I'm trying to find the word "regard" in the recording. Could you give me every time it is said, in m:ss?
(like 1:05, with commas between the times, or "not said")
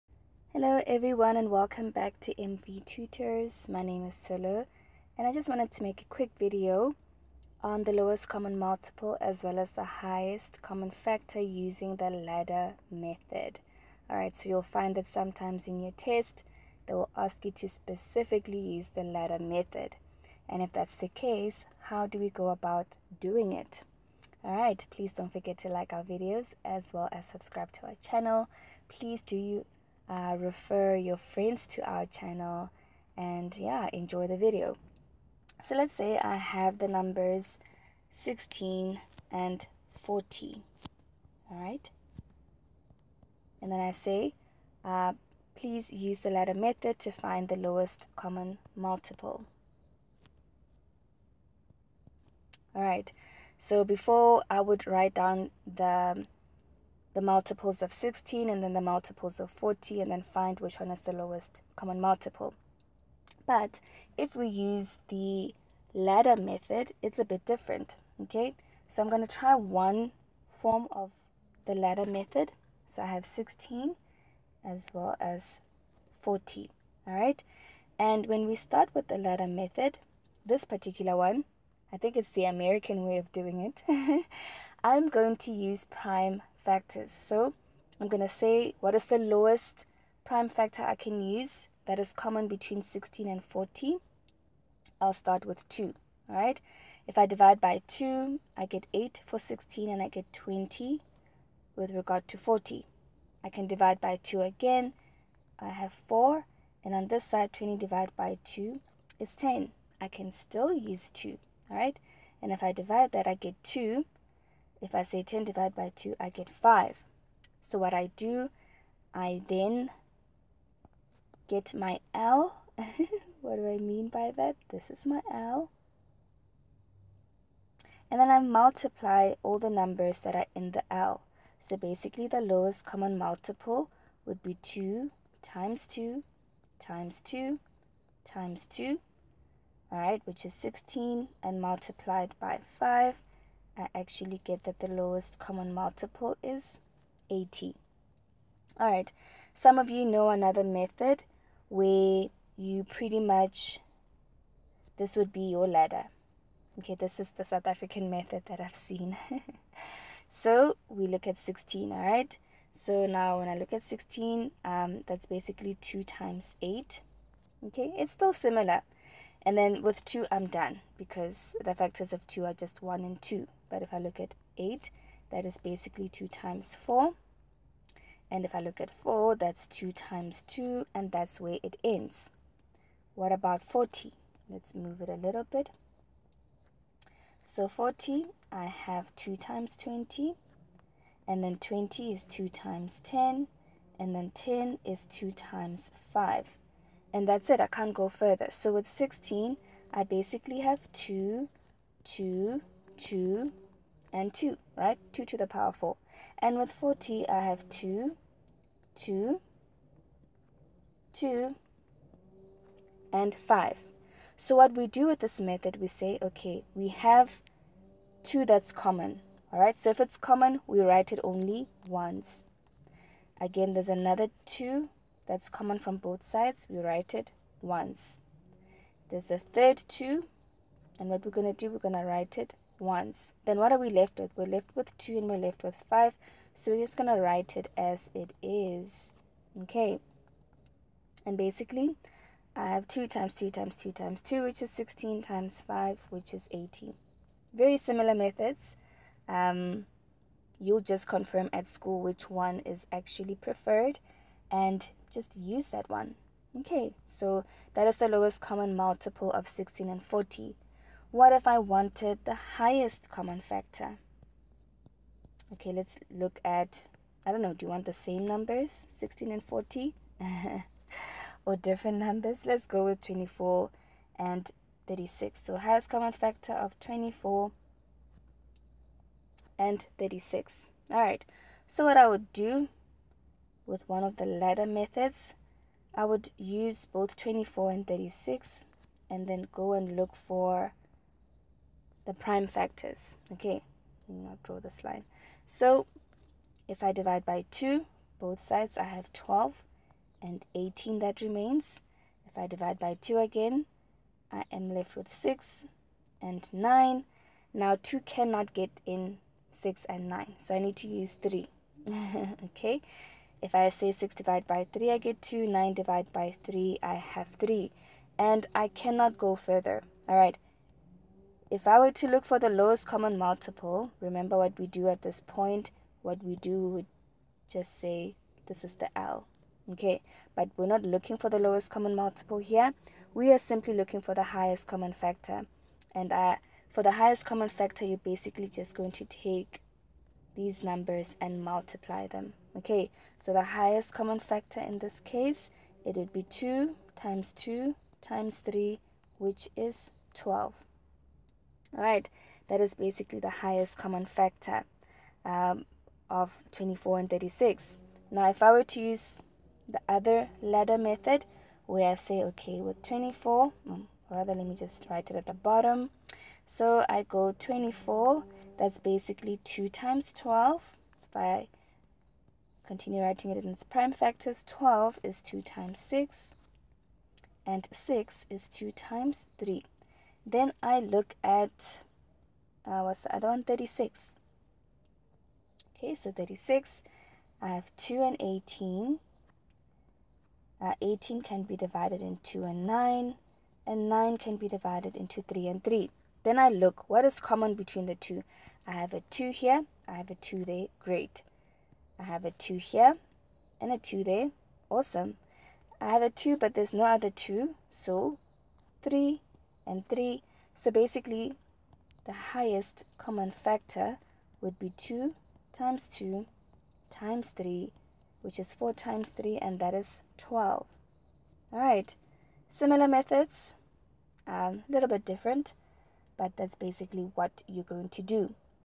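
1:41.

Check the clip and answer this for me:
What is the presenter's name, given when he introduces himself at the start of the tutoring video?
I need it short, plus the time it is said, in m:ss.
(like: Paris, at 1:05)
Solo, at 0:04.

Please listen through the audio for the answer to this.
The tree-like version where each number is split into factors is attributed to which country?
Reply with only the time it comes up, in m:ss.
2:37.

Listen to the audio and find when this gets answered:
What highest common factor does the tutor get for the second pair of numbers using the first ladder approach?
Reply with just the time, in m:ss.
5:49.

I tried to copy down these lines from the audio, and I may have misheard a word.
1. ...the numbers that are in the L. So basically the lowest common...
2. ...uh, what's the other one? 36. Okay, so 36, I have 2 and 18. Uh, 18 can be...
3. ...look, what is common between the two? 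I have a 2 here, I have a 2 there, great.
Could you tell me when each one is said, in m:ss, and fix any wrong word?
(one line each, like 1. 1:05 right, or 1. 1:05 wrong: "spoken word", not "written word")
1. 2:09 right
2. 6:22 right
3. 6:36 right.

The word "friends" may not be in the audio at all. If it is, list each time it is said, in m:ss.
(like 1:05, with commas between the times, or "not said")
0:31.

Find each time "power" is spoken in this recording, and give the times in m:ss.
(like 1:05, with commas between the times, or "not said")
3:25.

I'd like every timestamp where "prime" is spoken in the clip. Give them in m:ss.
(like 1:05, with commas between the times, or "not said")
1:25, 1:30, 4:52, 6:13.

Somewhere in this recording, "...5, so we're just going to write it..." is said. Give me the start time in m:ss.
3:55.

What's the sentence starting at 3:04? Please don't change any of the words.
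Let's move it a little bit.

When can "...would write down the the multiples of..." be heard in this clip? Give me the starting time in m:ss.
0:54.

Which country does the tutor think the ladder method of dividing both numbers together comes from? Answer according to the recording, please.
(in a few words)
American.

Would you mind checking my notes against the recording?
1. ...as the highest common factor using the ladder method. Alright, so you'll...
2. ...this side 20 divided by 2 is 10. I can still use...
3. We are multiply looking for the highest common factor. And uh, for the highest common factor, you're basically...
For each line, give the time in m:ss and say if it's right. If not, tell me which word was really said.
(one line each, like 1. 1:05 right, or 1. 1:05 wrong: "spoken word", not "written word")
1. 0:09 right
2. 1:47 right
3. 5:33 wrong: "simply", not "multiply".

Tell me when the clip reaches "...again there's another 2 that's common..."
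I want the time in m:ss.
3:43.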